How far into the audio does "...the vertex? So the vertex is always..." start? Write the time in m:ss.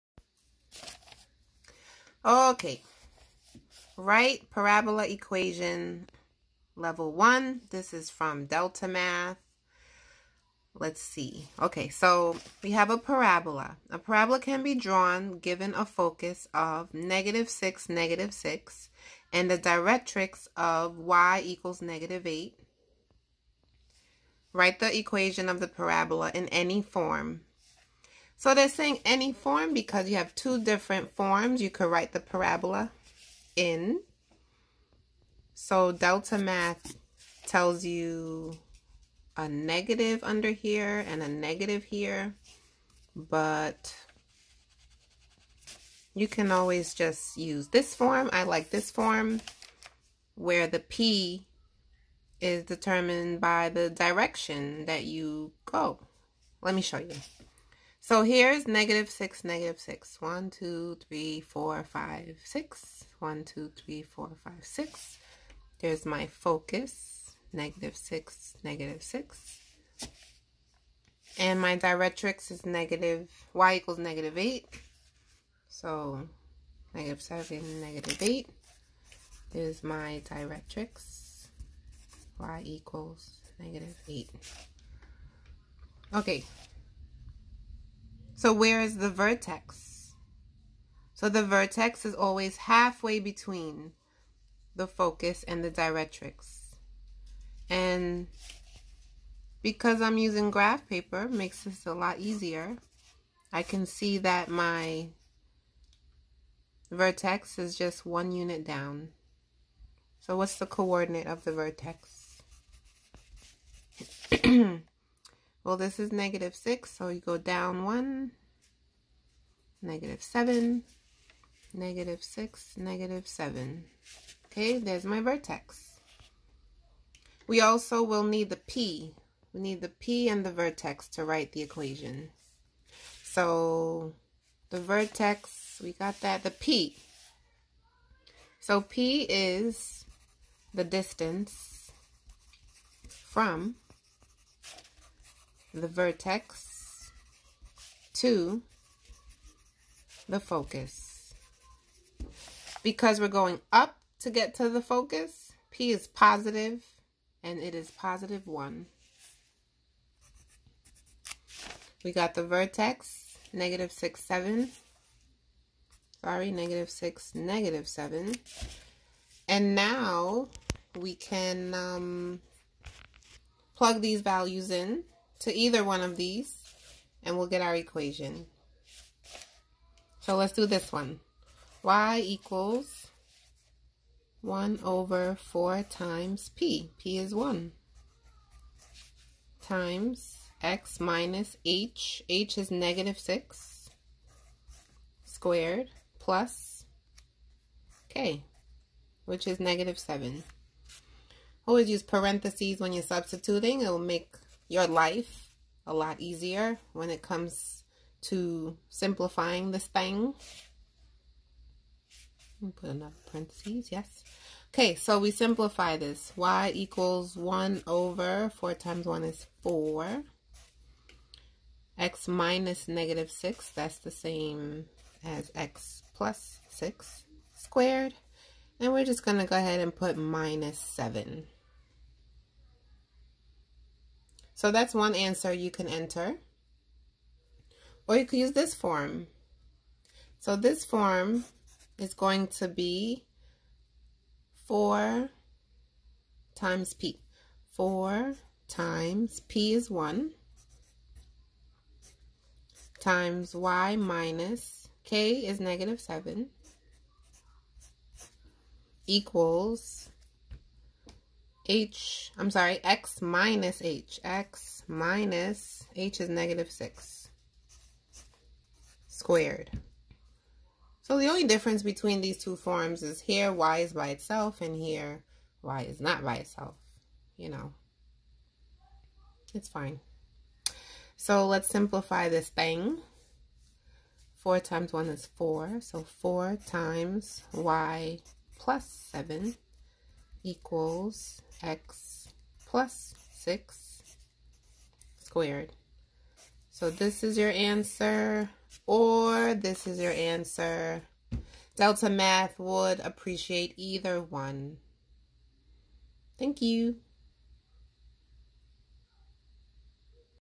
1:28.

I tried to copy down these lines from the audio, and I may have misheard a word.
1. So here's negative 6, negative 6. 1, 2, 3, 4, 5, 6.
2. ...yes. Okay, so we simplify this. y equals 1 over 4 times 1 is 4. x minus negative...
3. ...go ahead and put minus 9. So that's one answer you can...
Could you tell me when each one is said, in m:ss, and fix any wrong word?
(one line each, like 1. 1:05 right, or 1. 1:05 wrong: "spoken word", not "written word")
1. 0:58 right
2. 3:33 right
3. 3:49 wrong: "7", not "9".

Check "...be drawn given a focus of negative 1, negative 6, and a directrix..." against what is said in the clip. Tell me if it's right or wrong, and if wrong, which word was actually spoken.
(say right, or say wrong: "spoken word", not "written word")
wrong: "6", not "1".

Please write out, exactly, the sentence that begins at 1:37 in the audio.
And because I'm using graph paper, makes this a lot easier.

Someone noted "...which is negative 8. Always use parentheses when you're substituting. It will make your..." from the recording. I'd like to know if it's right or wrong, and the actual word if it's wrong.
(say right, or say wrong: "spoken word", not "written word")
wrong: "7", not "8".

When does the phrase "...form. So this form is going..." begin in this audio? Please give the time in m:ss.
3:58.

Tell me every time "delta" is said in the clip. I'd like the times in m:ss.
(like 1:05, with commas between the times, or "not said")
0:08, 0:35, 5:01.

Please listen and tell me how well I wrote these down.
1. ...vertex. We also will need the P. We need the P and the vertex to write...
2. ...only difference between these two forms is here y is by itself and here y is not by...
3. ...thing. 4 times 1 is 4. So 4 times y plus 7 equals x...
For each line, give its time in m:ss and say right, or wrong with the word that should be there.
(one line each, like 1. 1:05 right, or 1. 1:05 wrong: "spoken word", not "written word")
1. 2:05 right
2. 4:31 right
3. 4:42 right.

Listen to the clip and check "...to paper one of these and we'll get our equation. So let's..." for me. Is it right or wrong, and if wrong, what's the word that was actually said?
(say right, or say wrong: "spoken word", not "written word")
wrong: "either", not "paper".